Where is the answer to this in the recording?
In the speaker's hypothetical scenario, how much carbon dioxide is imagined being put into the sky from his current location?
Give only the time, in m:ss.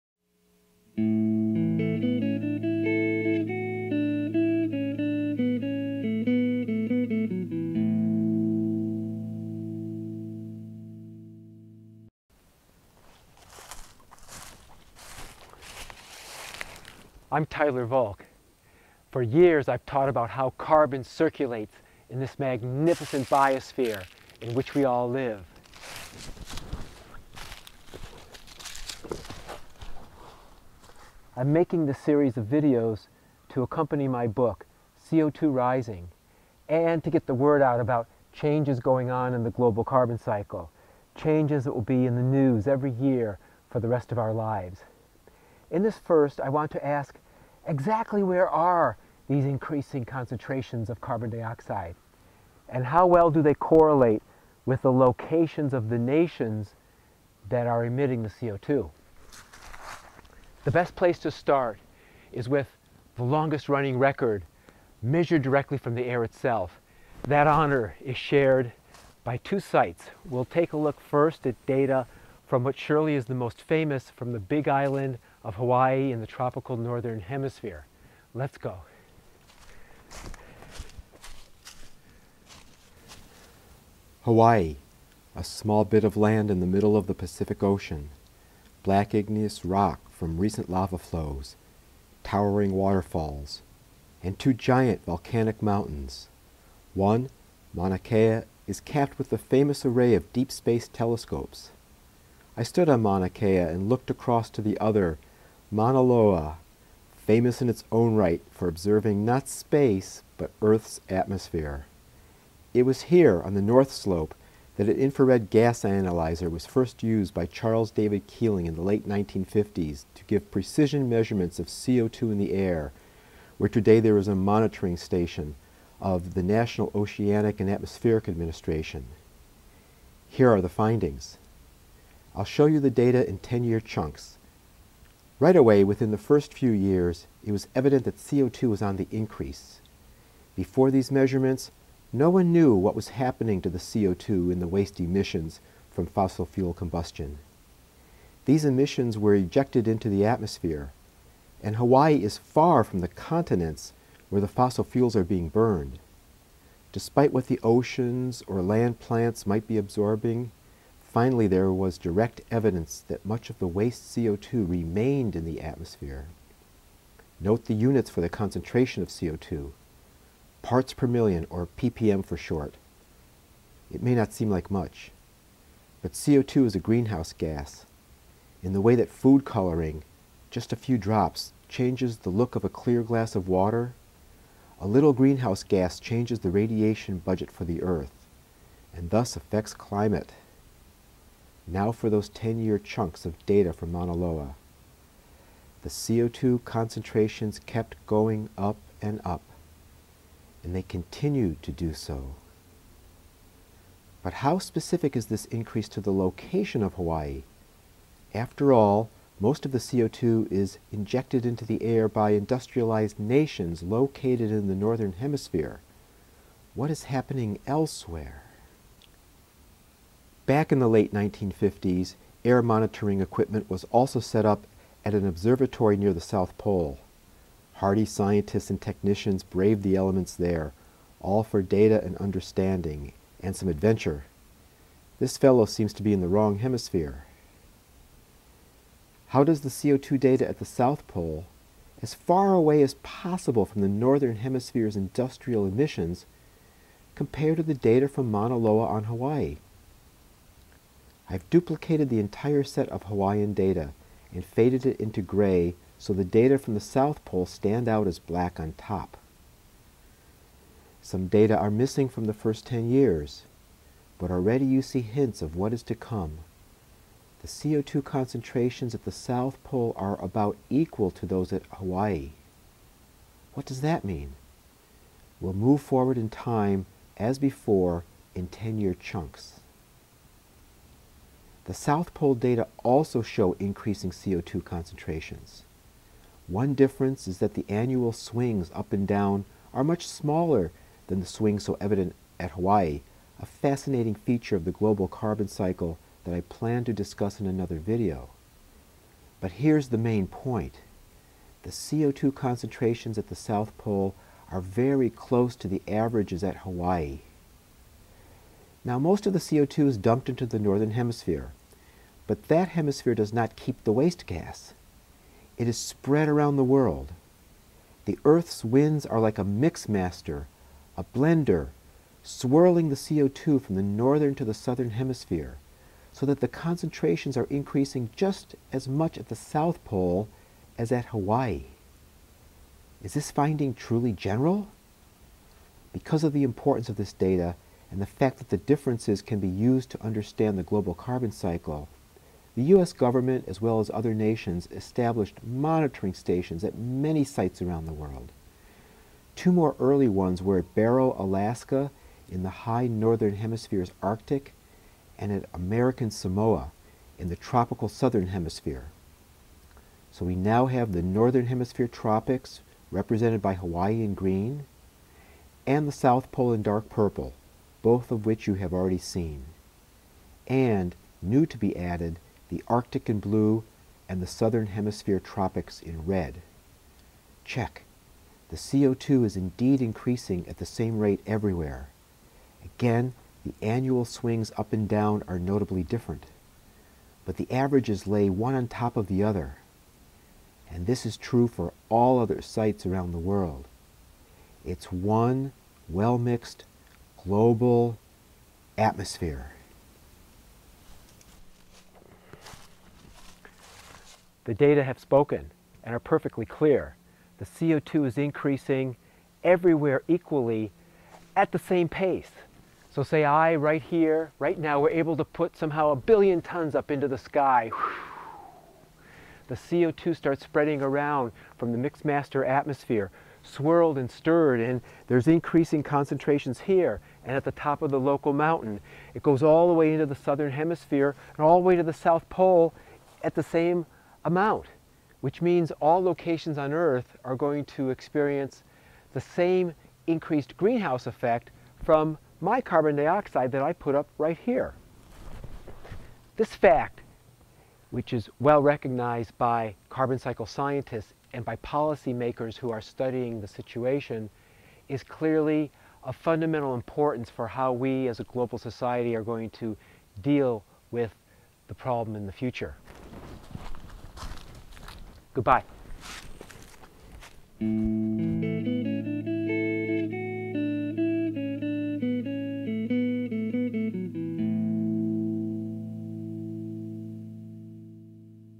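6:55.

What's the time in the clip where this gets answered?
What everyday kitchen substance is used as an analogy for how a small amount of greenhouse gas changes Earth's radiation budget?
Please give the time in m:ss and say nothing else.
2:59.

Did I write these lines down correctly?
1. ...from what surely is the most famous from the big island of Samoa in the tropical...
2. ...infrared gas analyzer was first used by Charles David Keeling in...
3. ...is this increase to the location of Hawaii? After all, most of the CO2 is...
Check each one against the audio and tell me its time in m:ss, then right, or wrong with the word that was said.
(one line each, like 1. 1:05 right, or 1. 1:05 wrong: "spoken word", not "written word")
1. 1:12 wrong: "Hawaii", not "Samoa"
2. 1:54 right
3. 3:25 right.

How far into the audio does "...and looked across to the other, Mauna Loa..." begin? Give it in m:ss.
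1:43.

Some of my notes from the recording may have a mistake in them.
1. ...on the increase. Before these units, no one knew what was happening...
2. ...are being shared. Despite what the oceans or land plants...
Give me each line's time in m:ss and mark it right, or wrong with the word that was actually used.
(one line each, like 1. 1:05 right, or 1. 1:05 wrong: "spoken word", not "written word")
1. 2:18 wrong: "measurements", not "units"
2. 2:35 wrong: "burned", not "shared".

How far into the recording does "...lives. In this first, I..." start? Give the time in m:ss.
0:44.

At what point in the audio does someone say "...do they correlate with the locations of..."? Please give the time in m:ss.
0:53.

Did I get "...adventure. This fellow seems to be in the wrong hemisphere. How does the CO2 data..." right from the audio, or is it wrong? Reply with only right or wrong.
right.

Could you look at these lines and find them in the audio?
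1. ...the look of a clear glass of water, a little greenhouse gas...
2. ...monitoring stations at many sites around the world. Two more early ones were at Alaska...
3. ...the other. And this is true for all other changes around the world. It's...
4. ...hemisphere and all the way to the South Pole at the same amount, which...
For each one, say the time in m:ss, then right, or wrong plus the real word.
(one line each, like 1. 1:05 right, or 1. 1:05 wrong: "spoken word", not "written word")
1. 3:02 right
2. 5:45 wrong: "Barrow", not "Alaska"
3. 6:29 wrong: "sites", not "changes"
4. 7:10 right.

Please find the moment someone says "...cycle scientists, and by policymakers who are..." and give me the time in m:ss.
7:30.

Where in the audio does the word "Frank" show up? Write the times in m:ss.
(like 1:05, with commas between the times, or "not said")
not said.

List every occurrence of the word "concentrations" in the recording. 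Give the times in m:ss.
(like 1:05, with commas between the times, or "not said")
0:50, 2:48, 3:16, 4:28, 4:44, 5:02, 5:26, 7:05.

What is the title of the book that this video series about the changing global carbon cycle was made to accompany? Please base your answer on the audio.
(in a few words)
CO2 Rising.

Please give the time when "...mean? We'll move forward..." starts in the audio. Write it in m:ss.
4:34.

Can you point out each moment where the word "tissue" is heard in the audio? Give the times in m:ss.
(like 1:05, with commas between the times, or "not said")
not said.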